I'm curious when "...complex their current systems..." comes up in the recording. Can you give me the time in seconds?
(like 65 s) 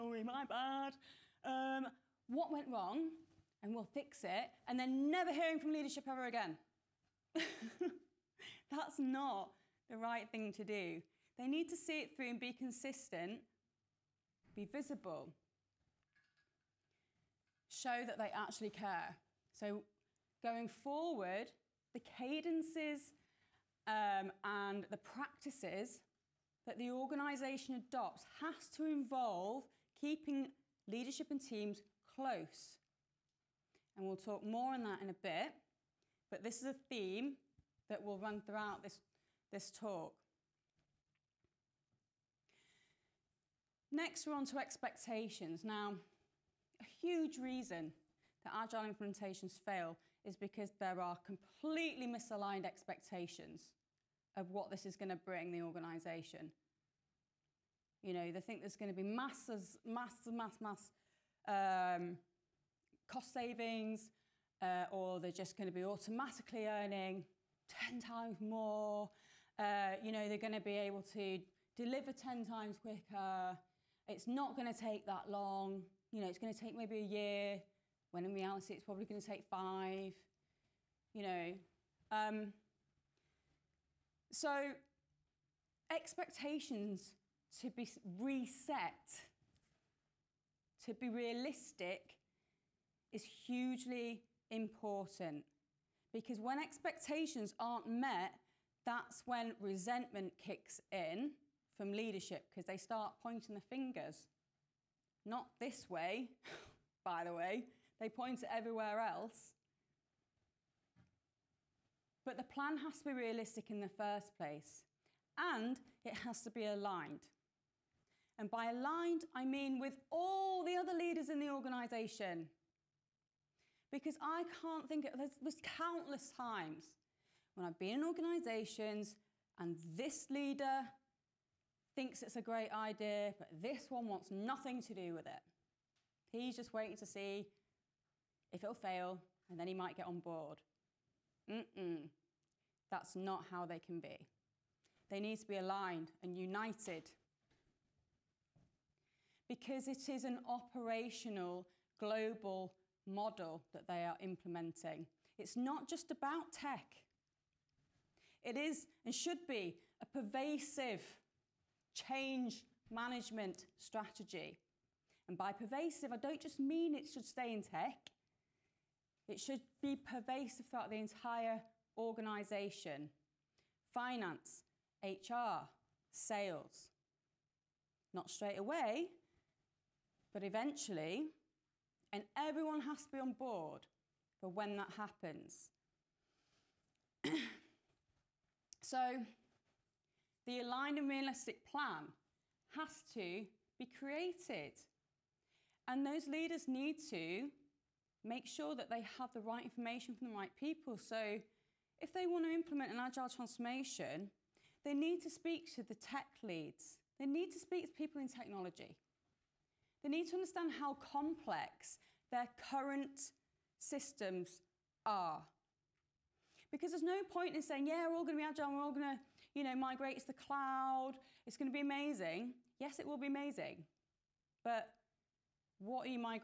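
210 s.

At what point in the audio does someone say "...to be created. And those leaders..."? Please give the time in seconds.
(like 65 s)
193 s.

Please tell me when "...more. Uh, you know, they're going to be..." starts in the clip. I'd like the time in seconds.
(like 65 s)
68 s.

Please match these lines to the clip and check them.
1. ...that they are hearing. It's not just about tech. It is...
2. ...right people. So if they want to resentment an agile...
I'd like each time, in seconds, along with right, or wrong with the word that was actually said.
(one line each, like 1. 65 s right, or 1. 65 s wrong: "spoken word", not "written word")
1. 153 s wrong: "implementing", not "hearing"
2. 200 s wrong: "implement", not "resentment".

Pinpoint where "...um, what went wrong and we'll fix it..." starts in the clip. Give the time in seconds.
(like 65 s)
1 s.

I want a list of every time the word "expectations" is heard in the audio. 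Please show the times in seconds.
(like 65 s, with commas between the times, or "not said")
44 s, 52 s, 85 s, 96 s.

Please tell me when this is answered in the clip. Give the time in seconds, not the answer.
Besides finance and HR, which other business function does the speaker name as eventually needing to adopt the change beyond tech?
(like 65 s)
176 s.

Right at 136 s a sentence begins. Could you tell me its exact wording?
He's just waiting to see if it'll fail, and then he might get on board.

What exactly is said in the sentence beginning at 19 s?
So going forward, the cadences um, and the practices that the organisation adopts has to involve keeping leadership and teams close.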